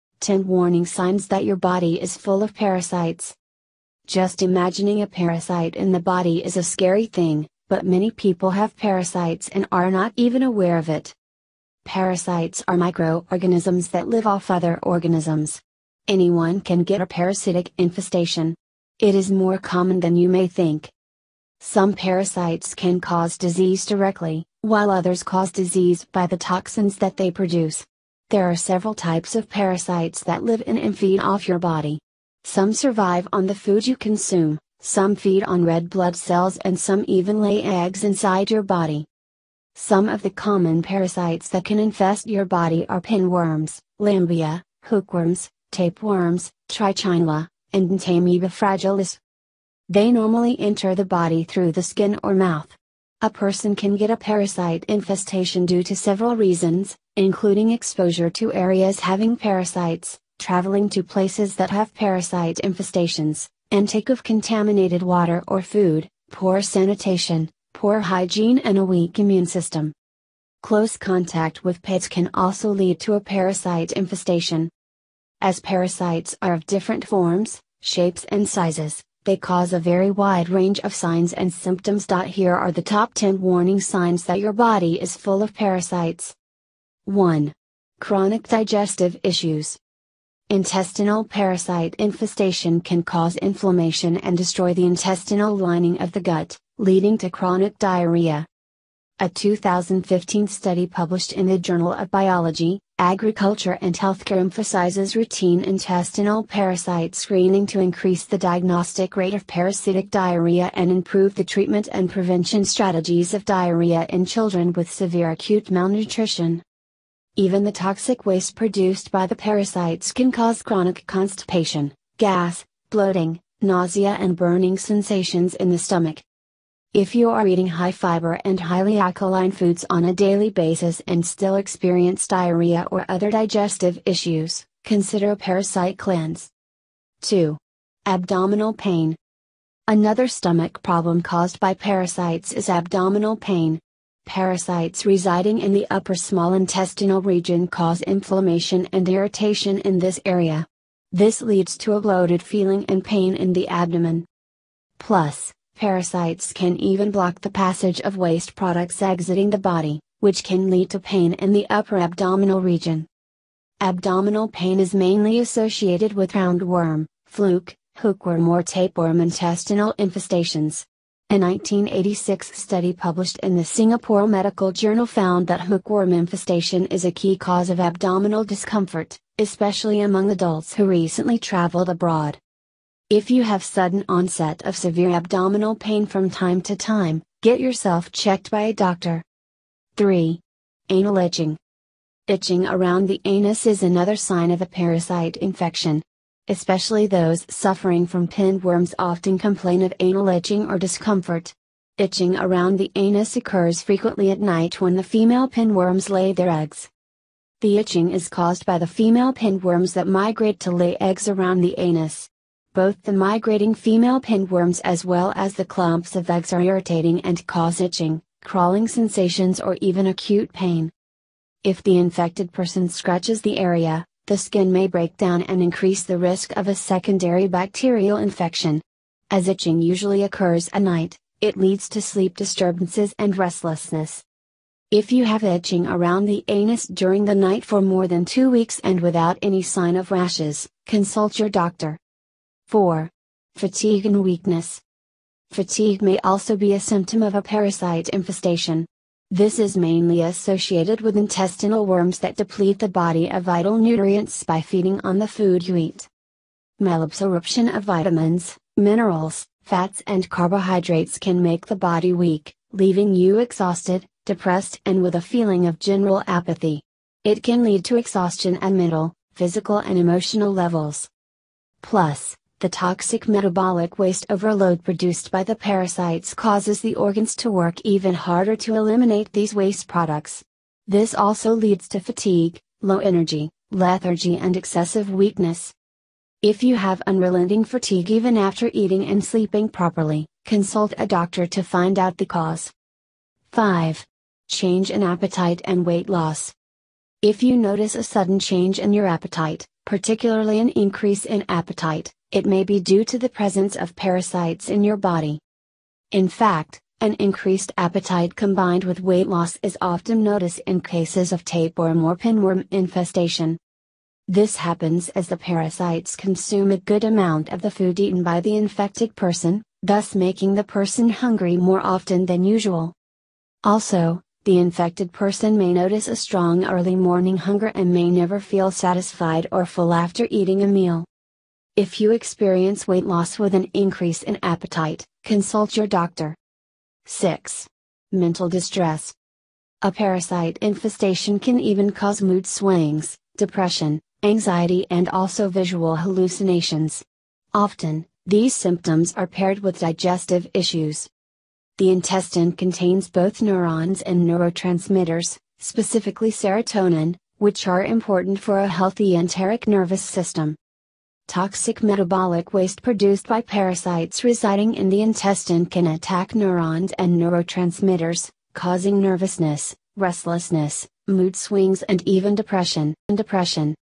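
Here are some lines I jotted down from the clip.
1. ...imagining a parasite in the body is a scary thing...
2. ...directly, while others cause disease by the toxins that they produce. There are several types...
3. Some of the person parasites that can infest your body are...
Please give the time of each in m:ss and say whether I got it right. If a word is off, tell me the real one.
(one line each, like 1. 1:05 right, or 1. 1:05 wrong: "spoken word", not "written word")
1. 0:04 right
2. 0:23 right
3. 0:39 wrong: "common", not "person".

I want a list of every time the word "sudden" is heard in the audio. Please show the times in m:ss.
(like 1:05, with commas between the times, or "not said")
3:03, 4:58.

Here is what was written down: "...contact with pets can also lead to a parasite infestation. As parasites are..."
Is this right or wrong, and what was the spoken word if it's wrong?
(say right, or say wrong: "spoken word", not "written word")
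right.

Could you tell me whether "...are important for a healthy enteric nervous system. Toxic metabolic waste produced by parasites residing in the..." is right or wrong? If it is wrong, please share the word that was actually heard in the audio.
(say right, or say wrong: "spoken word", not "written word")
right.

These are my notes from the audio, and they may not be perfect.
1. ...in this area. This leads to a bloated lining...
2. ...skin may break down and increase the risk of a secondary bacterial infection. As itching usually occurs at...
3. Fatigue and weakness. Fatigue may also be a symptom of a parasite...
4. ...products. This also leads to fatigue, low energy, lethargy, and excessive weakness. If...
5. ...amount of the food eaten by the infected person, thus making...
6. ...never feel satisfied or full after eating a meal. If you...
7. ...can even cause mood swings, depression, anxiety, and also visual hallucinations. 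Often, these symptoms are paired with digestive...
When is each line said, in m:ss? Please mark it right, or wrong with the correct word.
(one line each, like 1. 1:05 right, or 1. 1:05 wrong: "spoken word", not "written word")
1. 2:29 wrong: "feeling", not "lining"
2. 3:44 right
3. 4:03 right
4. 4:39 right
5. 5:17 right
6. 5:28 right
7. 5:41 right.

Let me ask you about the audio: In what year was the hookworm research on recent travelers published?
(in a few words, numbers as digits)
1986.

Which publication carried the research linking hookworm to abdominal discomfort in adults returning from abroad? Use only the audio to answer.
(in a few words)
Singapore Medical Journal.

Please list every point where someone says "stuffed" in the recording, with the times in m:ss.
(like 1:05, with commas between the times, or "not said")
not said.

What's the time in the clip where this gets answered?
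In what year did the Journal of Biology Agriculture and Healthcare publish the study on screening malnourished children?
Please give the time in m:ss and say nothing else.
1:39.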